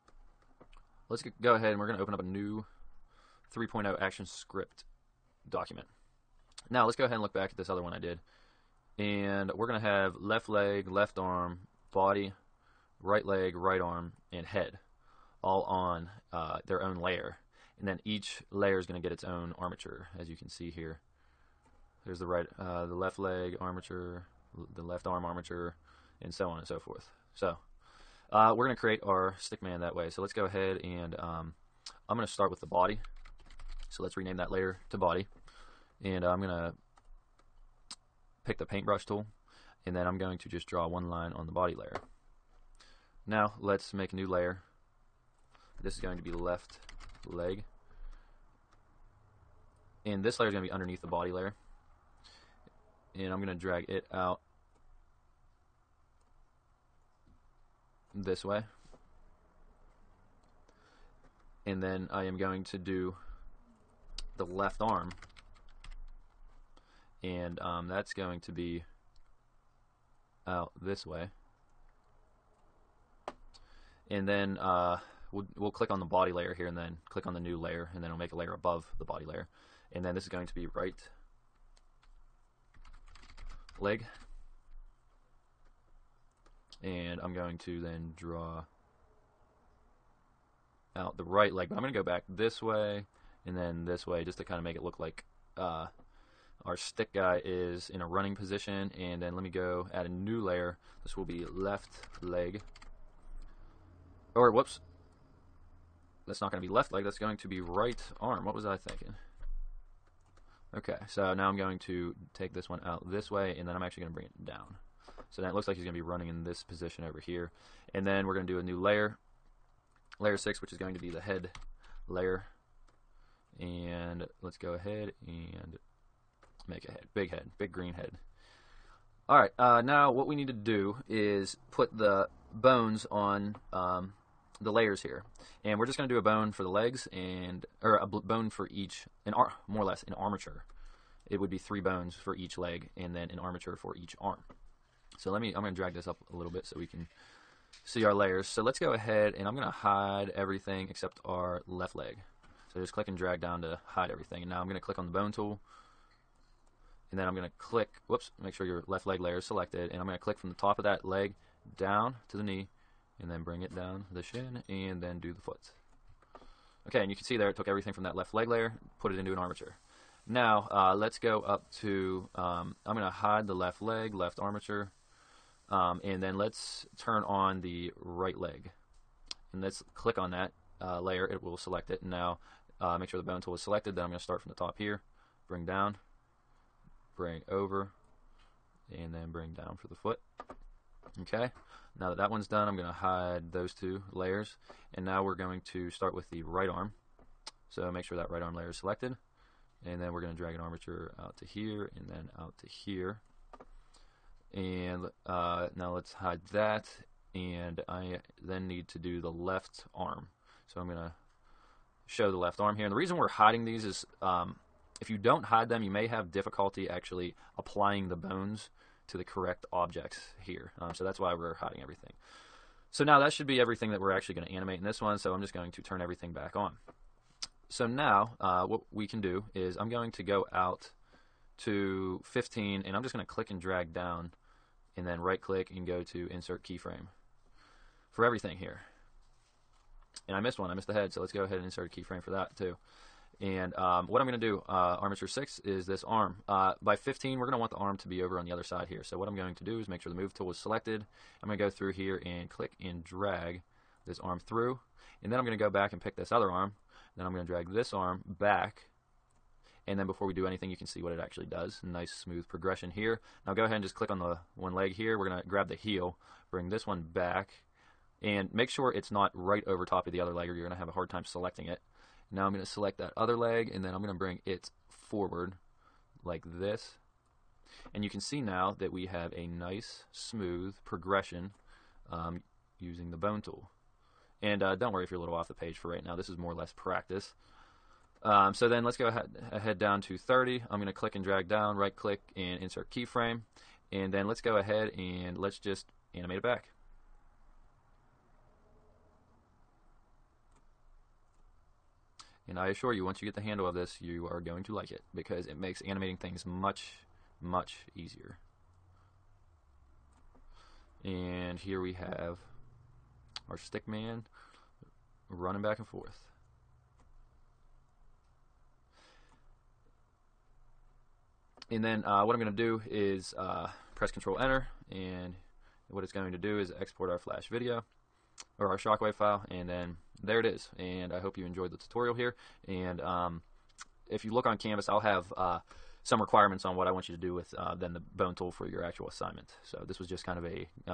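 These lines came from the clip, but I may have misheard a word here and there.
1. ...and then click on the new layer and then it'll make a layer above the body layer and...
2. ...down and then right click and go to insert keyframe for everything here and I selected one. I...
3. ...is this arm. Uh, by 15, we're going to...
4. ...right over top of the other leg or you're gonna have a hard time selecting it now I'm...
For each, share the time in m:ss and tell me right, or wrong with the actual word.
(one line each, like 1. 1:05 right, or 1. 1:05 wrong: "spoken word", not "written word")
1. 1:16 right
2. 3:53 wrong: "missed", not "selected"
3. 4:05 right
4. 4:29 right.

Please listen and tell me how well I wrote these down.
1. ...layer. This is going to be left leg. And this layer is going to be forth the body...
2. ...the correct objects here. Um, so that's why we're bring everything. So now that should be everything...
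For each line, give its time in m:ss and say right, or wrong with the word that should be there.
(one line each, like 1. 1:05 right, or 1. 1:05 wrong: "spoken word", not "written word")
1. 0:44 wrong: "underneath", not "forth"
2. 3:39 wrong: "hiding", not "bring".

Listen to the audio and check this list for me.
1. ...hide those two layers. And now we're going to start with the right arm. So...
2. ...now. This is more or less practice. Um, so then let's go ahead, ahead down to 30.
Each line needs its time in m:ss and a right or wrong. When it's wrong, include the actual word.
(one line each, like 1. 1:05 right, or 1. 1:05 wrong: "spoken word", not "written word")
1. 3:12 right
2. 4:46 right.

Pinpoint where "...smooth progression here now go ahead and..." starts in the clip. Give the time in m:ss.
4:22.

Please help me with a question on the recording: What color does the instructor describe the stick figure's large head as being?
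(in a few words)
Green.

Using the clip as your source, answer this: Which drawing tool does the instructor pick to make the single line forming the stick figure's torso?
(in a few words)
paintbrush tool.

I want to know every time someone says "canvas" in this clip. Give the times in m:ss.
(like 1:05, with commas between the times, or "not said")
5:34.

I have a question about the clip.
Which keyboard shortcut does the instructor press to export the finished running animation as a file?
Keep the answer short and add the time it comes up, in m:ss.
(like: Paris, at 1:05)
Control Enter, at 5:24.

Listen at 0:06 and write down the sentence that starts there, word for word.
Now let's go ahead and look back at this other one I did.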